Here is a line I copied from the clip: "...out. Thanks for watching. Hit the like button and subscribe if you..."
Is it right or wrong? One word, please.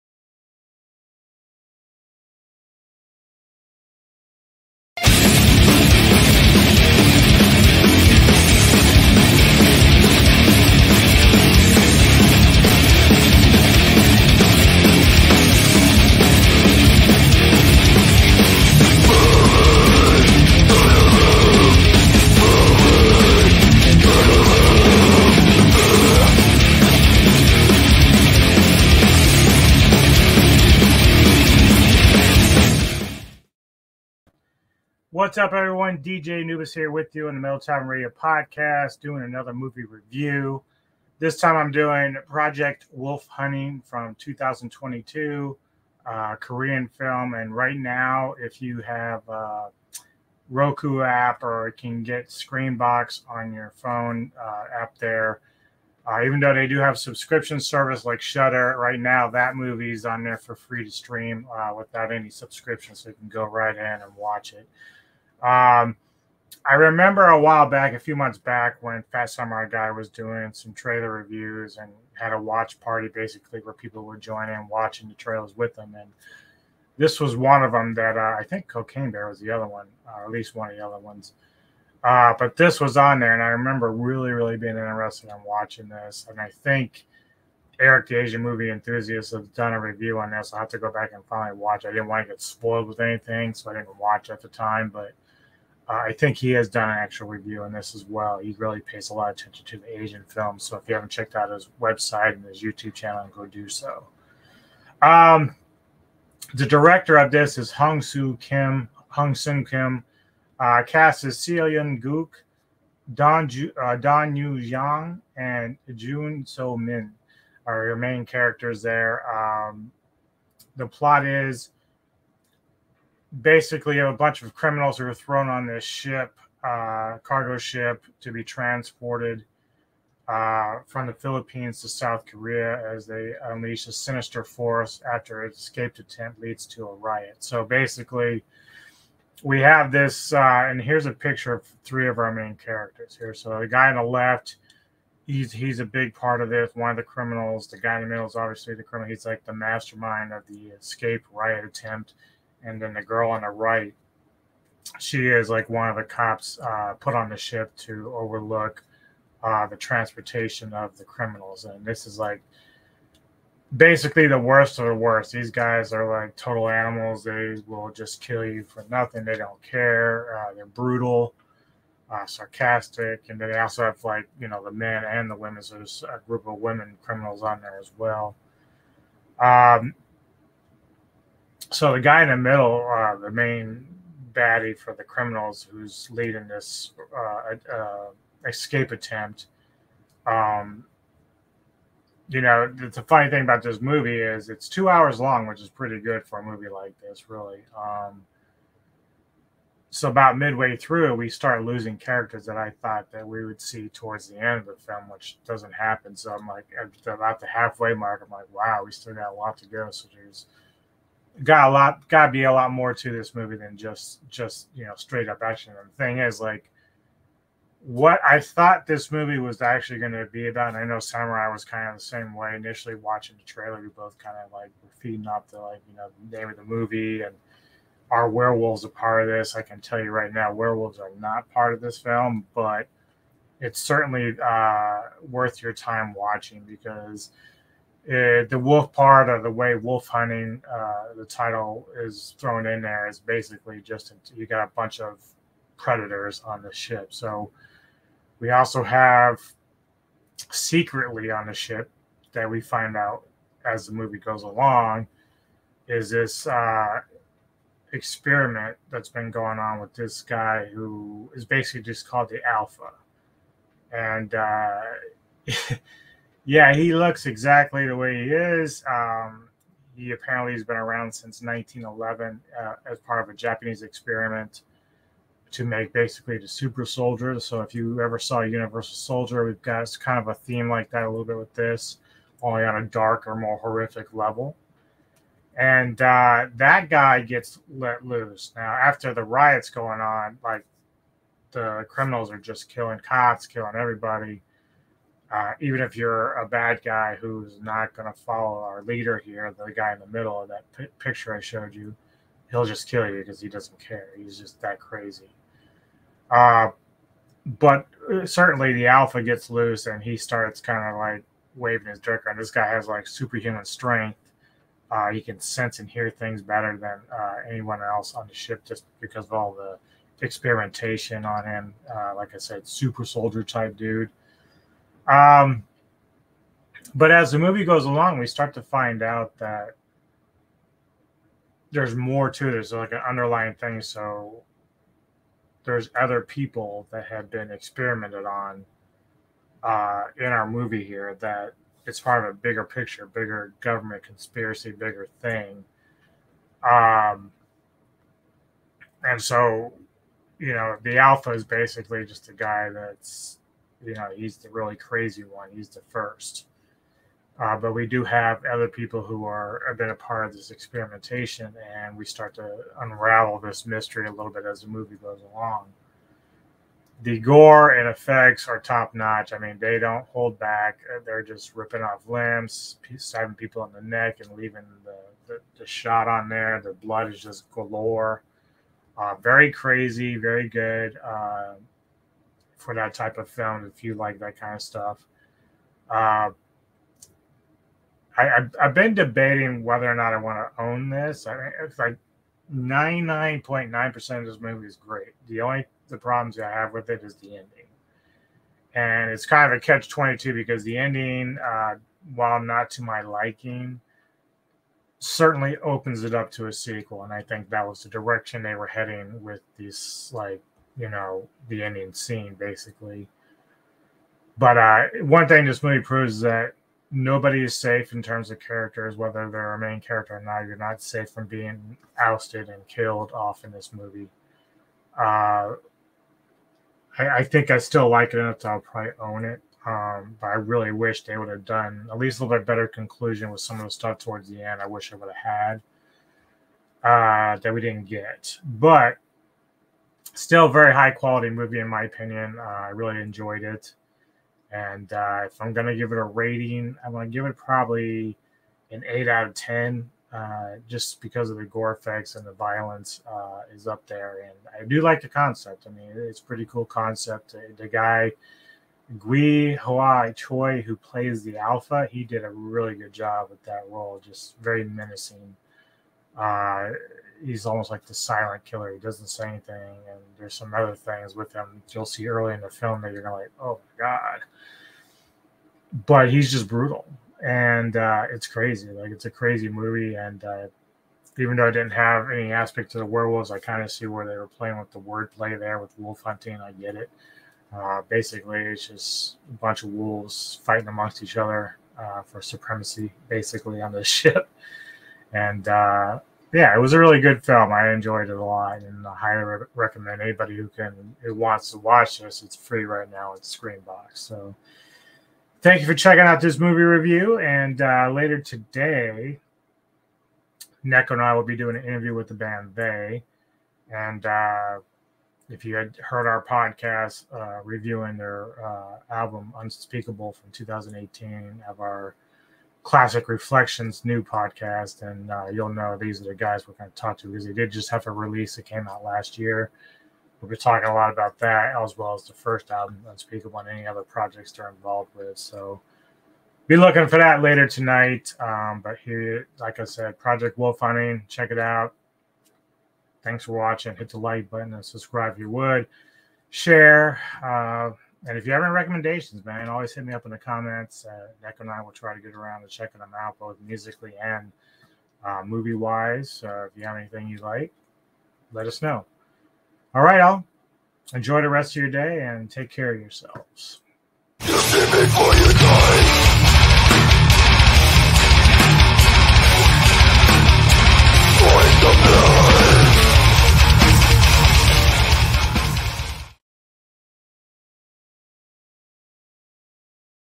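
right.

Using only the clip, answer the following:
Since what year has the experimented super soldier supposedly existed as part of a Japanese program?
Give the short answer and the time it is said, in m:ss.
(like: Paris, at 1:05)
1911, at 4:31.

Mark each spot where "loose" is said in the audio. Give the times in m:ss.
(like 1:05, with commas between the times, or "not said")
4:48, 5:09.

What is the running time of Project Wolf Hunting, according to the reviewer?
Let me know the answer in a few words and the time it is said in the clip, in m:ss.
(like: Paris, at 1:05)
2 hours, at 3:14.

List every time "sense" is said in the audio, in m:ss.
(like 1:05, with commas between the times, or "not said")
5:15.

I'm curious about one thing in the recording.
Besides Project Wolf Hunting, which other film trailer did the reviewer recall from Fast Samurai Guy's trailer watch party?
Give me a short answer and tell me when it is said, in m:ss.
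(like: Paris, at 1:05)
Cocaine Bear, at 1:18.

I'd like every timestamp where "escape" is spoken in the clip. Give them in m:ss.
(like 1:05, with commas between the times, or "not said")
2:15, 2:30, 3:08.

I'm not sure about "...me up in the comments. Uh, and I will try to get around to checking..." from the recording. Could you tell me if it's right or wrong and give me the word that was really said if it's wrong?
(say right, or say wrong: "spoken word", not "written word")
right.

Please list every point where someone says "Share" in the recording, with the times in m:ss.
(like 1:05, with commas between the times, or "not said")
9:06.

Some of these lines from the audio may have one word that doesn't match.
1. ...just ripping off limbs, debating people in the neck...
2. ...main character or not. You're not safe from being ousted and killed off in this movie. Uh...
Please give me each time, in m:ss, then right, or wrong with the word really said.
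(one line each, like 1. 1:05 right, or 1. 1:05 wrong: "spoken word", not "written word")
1. 6:11 wrong: "stabbing", not "debating"
2. 6:59 right.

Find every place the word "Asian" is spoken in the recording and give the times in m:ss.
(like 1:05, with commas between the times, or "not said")
1:28, 1:39.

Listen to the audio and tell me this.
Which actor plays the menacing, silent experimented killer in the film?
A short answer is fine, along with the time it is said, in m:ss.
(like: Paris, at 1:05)
Gwi-hwa Choi, at 7:38.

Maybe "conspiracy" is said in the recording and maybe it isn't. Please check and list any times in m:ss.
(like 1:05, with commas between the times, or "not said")
5:44.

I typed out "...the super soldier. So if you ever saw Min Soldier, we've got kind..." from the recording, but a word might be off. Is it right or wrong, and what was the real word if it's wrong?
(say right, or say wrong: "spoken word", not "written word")
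wrong: "Universal", not "Min".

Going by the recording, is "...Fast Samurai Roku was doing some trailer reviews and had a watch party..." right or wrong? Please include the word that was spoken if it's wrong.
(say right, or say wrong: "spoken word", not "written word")
wrong: "Guy", not "Roku".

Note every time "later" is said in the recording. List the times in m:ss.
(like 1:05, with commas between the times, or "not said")
8:27, 8:57.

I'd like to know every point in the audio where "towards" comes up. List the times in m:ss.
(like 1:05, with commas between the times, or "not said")
3:23, 7:13.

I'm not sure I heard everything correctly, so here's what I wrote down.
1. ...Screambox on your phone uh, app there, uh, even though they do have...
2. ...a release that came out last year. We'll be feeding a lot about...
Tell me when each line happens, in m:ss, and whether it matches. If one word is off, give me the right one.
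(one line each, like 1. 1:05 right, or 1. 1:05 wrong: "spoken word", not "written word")
1. 0:52 right
2. 8:47 wrong: "talking", not "feeding".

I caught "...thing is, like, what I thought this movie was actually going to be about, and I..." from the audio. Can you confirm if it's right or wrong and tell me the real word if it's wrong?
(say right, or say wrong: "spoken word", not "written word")
right.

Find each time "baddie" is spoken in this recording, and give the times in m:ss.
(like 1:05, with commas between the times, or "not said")
3:04.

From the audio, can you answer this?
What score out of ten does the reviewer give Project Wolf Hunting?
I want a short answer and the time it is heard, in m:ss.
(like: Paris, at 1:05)
8, at 7:28.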